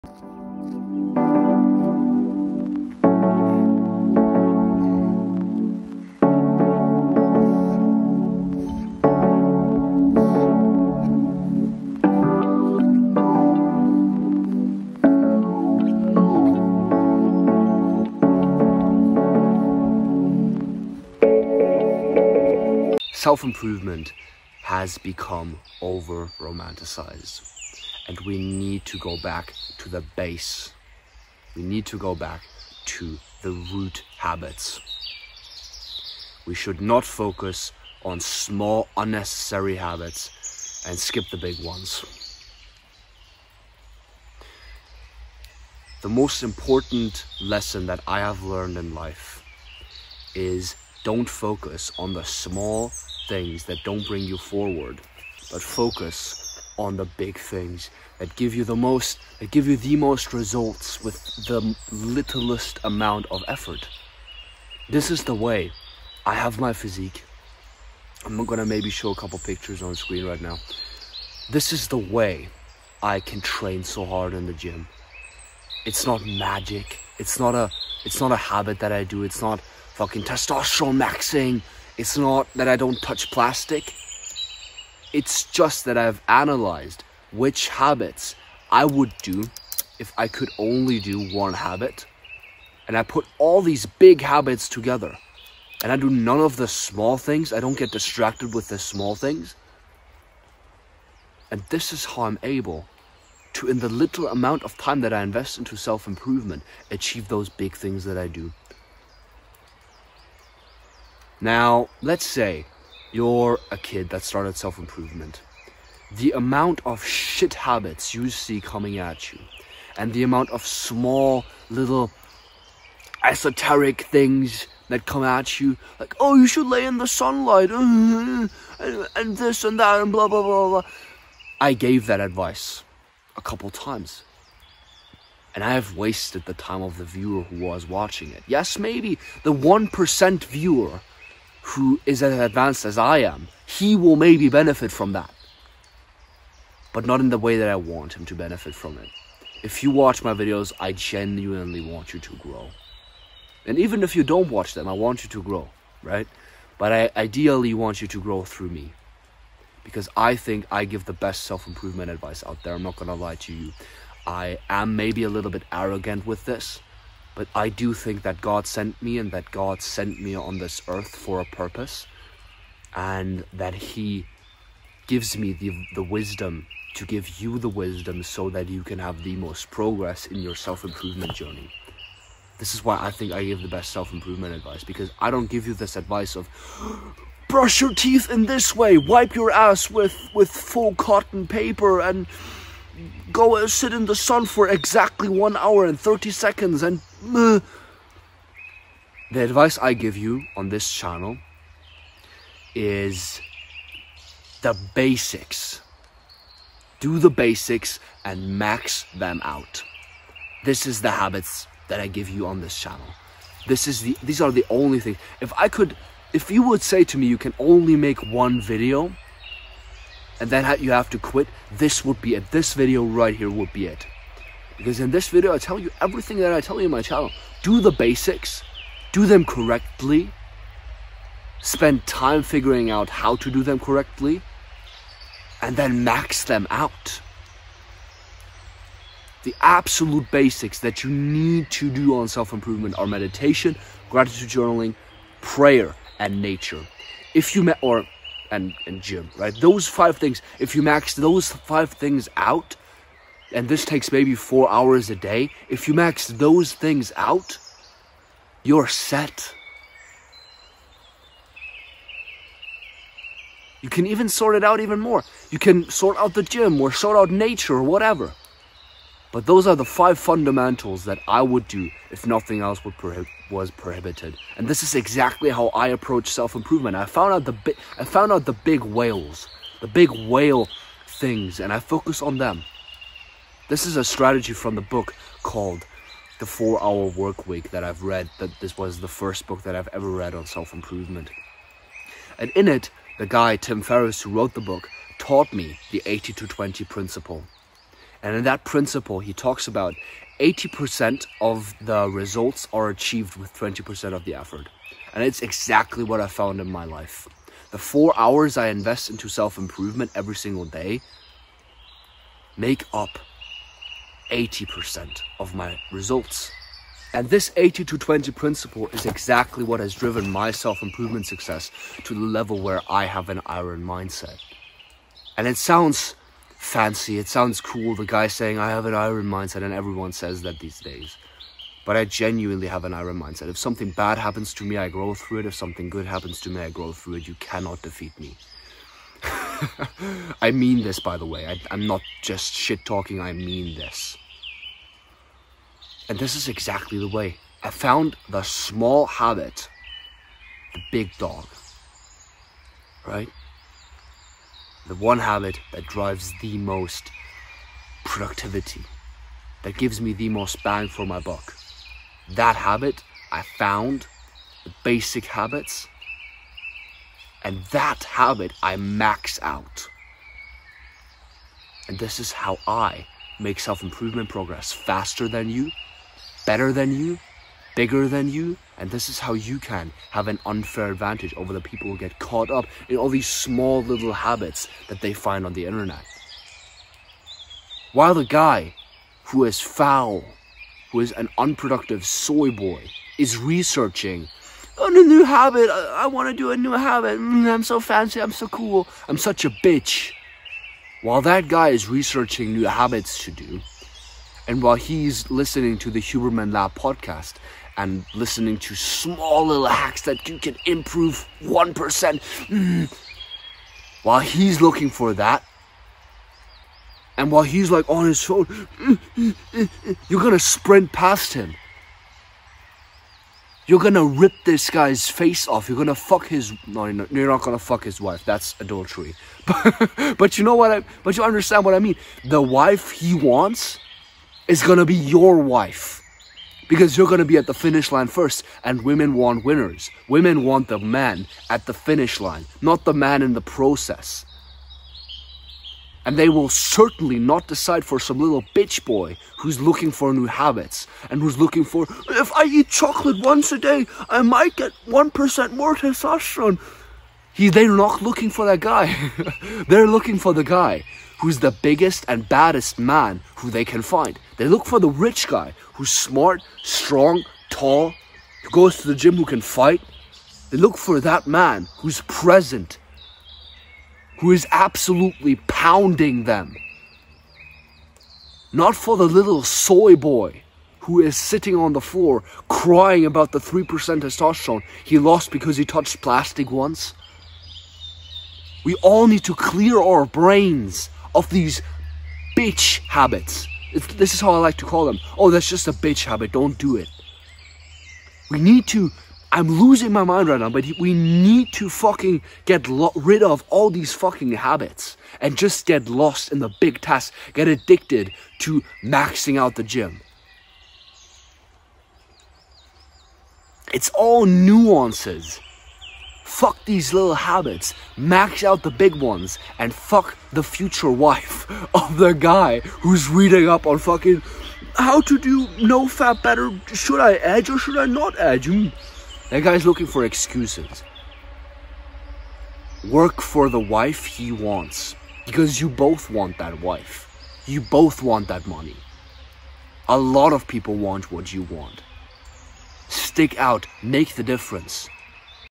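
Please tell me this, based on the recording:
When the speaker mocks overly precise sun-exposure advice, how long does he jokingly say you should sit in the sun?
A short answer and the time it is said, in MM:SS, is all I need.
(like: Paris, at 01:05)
1 hour and 30 seconds, at 03:15.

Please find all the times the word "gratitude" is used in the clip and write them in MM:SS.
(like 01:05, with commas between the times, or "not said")
04:04.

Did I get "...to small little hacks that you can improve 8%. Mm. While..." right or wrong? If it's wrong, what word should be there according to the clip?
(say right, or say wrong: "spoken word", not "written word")
wrong: "1", not "8".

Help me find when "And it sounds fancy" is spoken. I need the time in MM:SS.
05:25.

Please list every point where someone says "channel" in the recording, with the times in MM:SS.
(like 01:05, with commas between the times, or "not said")
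03:20, 03:32, 03:47.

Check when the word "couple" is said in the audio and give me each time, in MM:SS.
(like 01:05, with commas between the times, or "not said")
01:09, 02:13.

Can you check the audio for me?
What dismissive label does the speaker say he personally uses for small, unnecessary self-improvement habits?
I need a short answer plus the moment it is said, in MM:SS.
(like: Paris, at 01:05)
Bitch habit, at 08:15.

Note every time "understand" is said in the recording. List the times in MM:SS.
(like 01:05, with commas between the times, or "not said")
07:11.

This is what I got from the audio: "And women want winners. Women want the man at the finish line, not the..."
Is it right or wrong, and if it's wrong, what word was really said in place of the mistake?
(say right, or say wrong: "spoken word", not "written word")
right.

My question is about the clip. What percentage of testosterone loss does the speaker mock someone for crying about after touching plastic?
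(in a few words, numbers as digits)
3%.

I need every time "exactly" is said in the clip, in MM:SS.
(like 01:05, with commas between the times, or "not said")
03:14, 04:34, 05:05, 05:19, 05:46.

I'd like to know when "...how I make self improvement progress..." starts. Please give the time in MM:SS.
06:12.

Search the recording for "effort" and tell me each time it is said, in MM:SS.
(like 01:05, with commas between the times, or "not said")
01:03, 05:04.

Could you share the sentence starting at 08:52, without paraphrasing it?
Work for the wife he wants because you both want that wife.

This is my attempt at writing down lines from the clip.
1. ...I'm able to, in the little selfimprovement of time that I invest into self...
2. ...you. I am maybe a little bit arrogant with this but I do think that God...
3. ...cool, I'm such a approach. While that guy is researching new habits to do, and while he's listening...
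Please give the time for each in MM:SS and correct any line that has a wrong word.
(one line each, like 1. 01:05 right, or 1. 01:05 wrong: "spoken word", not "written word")
1. 01:42 wrong: "amount", not "selfimprovement"
2. 02:43 right
3. 06:38 wrong: "bitch", not "approach".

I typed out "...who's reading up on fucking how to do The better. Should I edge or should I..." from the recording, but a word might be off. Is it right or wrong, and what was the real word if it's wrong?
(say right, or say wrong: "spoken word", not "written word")
wrong: "NoFap", not "The".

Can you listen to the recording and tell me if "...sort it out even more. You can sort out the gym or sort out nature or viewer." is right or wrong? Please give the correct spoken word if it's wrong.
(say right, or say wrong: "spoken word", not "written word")
wrong: "whatever", not "viewer".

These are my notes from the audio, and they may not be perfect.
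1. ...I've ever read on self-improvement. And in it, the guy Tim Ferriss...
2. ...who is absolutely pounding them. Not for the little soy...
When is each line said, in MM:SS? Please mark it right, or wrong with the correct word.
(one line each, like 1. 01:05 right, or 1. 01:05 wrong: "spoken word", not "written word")
1. 04:49 right
2. 07:54 right.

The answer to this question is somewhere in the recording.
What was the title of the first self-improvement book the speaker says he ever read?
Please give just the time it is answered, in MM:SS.
04:46.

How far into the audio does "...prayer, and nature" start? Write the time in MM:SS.
04:05.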